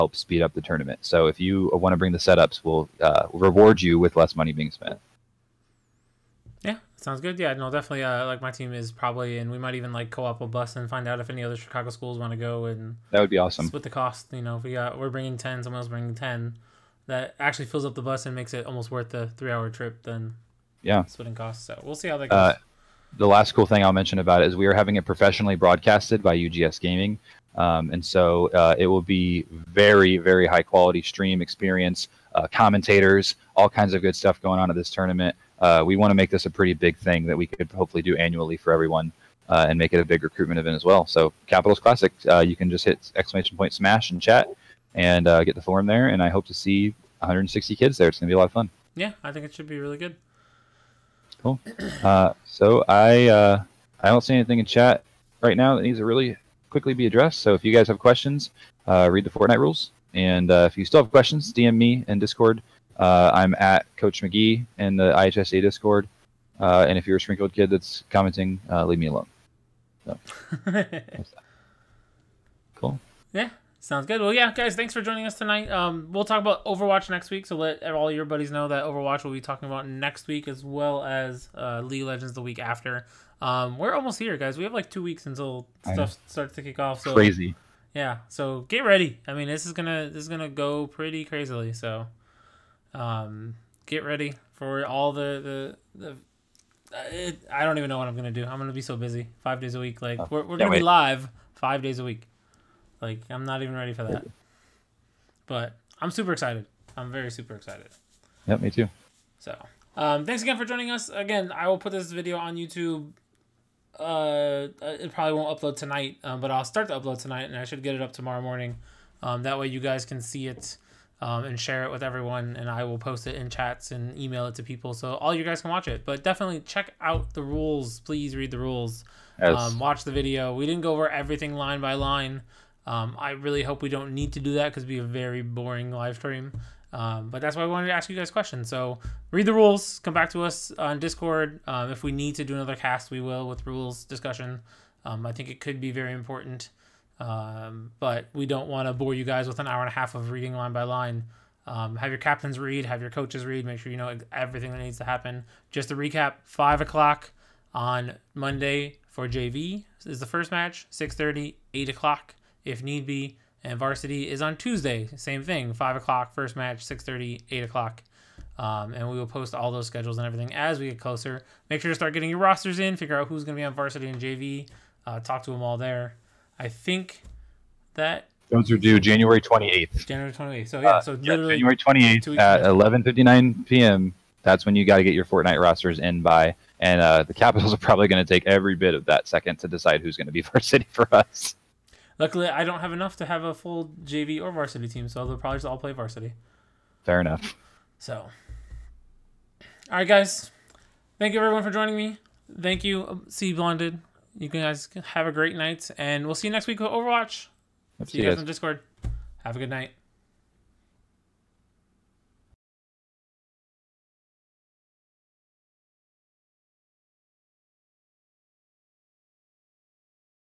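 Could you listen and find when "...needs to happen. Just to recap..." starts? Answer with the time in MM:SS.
02:34.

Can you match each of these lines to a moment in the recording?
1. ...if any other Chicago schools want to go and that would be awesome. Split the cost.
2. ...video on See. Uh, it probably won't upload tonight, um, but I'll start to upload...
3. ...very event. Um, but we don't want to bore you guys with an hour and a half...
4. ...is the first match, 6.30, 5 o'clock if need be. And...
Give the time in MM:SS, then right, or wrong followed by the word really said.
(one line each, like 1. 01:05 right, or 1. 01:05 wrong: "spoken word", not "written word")
1. 00:11 right
2. 01:52 wrong: "YouTube", not "See"
3. 02:25 wrong: "important", not "event"
4. 02:40 wrong: "8", not "5".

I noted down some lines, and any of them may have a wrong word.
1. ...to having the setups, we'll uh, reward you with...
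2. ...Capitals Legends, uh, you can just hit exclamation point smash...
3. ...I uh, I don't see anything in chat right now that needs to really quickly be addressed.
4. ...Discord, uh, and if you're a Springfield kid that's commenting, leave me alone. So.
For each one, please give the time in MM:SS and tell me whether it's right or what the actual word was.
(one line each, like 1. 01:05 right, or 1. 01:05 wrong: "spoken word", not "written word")
1. 00:01 wrong: "bring", not "having"
2. 00:41 wrong: "Classic", not "Legends"
3. 00:52 right
4. 01:05 right.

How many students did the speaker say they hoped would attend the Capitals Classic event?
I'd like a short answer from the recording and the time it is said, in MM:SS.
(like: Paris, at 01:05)
160, at 00:47.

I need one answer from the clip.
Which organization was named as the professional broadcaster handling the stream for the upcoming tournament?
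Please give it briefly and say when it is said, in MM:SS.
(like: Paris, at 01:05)
UGS Gaming, at 00:26.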